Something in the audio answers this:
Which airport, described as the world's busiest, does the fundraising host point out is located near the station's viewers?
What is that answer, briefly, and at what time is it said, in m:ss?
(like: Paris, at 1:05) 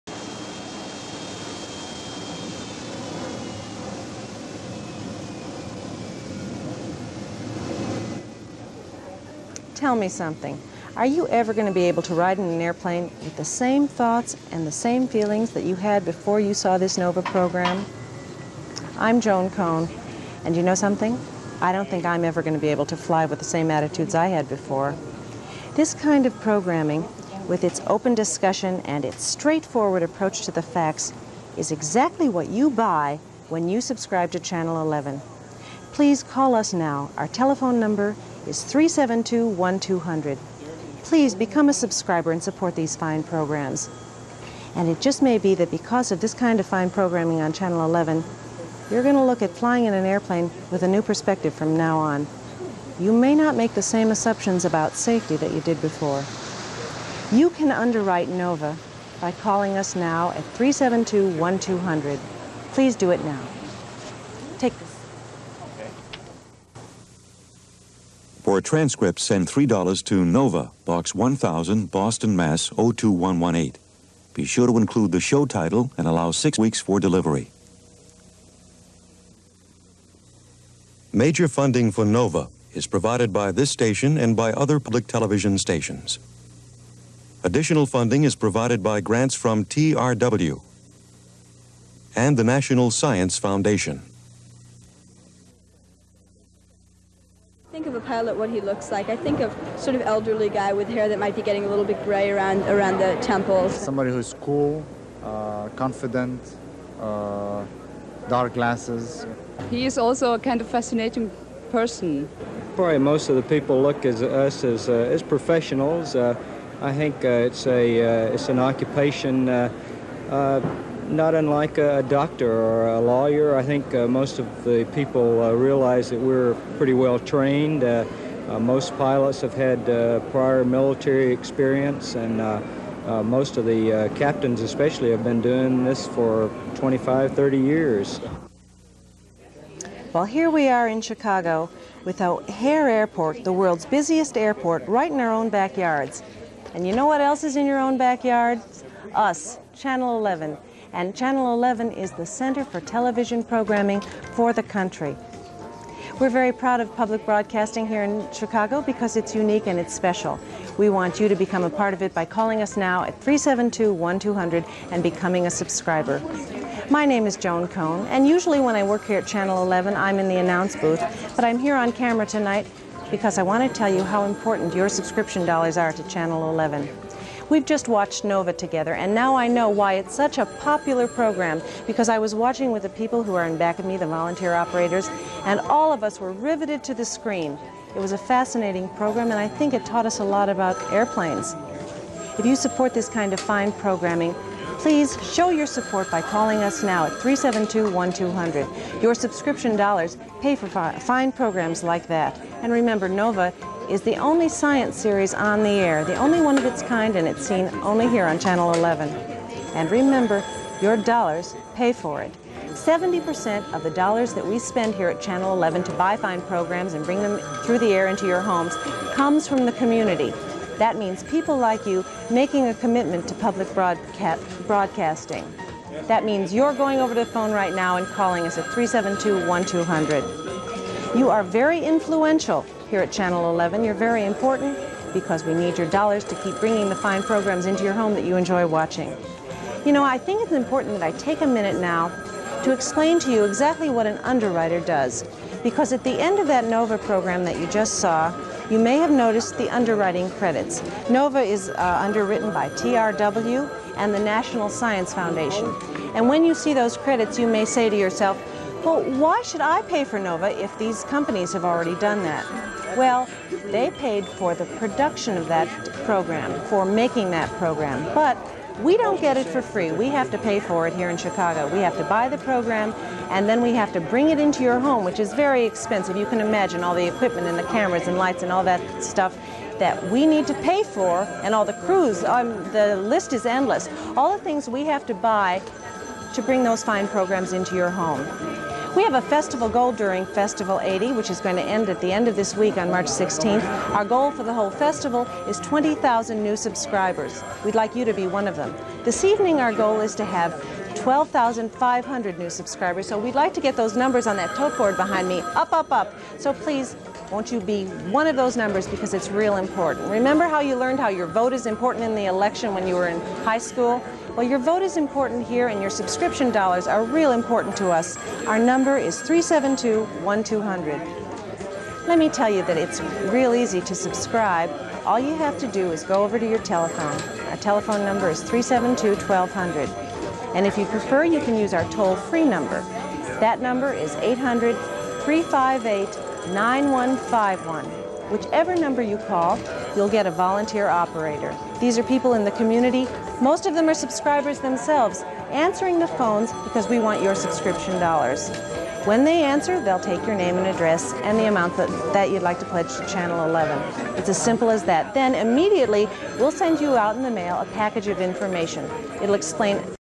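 O'Hare Airport, at 2:22.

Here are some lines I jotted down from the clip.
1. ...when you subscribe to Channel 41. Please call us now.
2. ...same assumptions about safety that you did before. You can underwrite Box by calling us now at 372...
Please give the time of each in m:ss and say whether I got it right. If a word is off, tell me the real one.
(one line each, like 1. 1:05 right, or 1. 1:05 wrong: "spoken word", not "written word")
1. 0:33 wrong: "11", not "41"
2. 0:53 wrong: "NOVA", not "Box".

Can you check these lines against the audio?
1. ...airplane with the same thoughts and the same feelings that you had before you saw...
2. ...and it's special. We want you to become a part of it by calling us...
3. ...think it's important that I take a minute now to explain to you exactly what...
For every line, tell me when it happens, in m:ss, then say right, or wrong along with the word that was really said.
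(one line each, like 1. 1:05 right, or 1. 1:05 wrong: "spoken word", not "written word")
1. 0:12 right
2. 2:39 right
3. 4:00 right.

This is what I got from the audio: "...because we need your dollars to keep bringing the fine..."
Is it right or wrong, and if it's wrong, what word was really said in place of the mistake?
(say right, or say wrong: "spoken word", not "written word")
right.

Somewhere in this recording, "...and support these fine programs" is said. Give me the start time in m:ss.
0:42.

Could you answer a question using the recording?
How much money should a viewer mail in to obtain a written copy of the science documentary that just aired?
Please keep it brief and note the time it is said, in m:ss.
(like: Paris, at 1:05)
$3, at 1:09.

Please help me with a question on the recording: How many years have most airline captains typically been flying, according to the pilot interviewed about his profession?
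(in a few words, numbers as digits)
25 to 30 years.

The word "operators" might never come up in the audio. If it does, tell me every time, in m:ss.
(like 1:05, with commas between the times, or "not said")
3:04, 5:40.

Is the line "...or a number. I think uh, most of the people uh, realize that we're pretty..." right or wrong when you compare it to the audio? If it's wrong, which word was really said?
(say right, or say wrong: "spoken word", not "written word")
wrong: "lawyer", not "number".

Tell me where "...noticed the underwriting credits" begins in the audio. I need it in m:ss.
4:09.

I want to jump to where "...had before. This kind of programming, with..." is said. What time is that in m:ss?
0:24.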